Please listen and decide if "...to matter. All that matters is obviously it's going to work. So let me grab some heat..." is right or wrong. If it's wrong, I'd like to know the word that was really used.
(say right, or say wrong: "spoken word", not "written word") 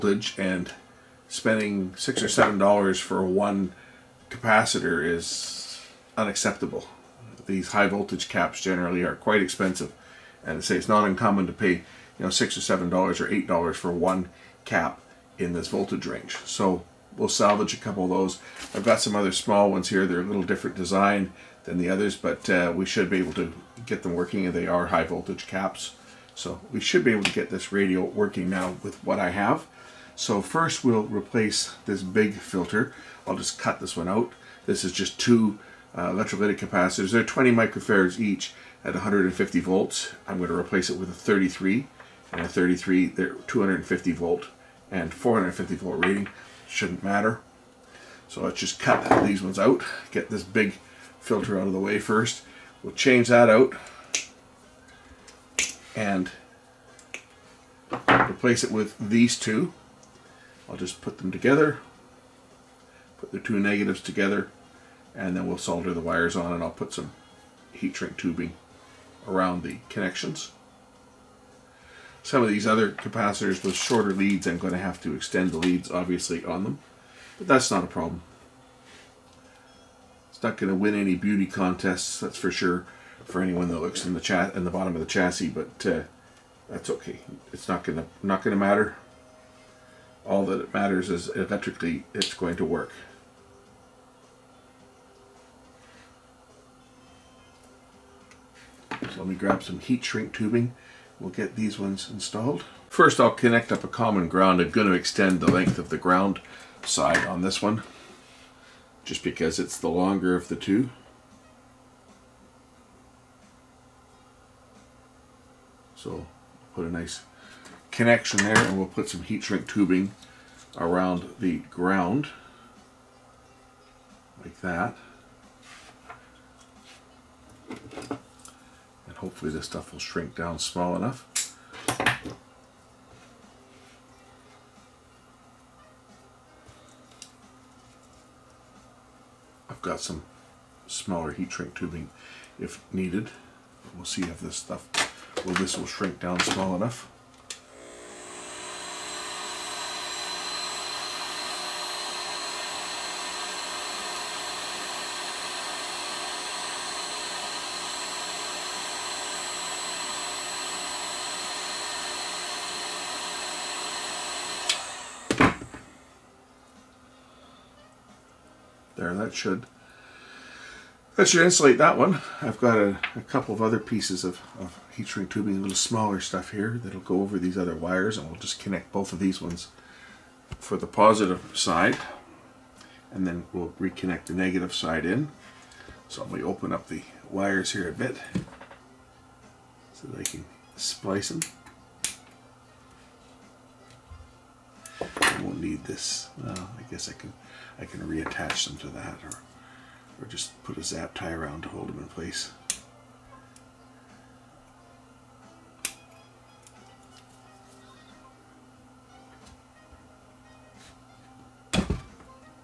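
wrong: "electrically", not "obviously".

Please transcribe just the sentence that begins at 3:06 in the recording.
So I'm going to open up the wires here a bit so that I can splice them.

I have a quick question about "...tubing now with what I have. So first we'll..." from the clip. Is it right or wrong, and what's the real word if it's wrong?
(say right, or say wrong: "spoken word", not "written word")
wrong: "working", not "tubing".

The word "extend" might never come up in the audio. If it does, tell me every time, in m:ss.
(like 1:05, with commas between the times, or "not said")
1:15, 1:44.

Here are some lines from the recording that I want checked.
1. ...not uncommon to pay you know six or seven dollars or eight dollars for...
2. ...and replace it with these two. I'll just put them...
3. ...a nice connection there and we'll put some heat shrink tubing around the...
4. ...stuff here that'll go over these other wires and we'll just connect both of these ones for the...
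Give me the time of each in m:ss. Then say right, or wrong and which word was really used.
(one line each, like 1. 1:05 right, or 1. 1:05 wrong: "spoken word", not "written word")
1. 0:10 right
2. 0:55 right
3. 1:56 right
4. 2:56 right.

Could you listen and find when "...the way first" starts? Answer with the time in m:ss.
0:51.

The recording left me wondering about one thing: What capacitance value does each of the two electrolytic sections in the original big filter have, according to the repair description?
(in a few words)
20 microfarads.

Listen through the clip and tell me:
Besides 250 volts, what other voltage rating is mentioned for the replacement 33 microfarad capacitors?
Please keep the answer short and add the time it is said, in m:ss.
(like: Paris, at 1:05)
450 volts, at 0:45.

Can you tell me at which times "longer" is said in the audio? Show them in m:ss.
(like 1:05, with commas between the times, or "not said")
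1:49.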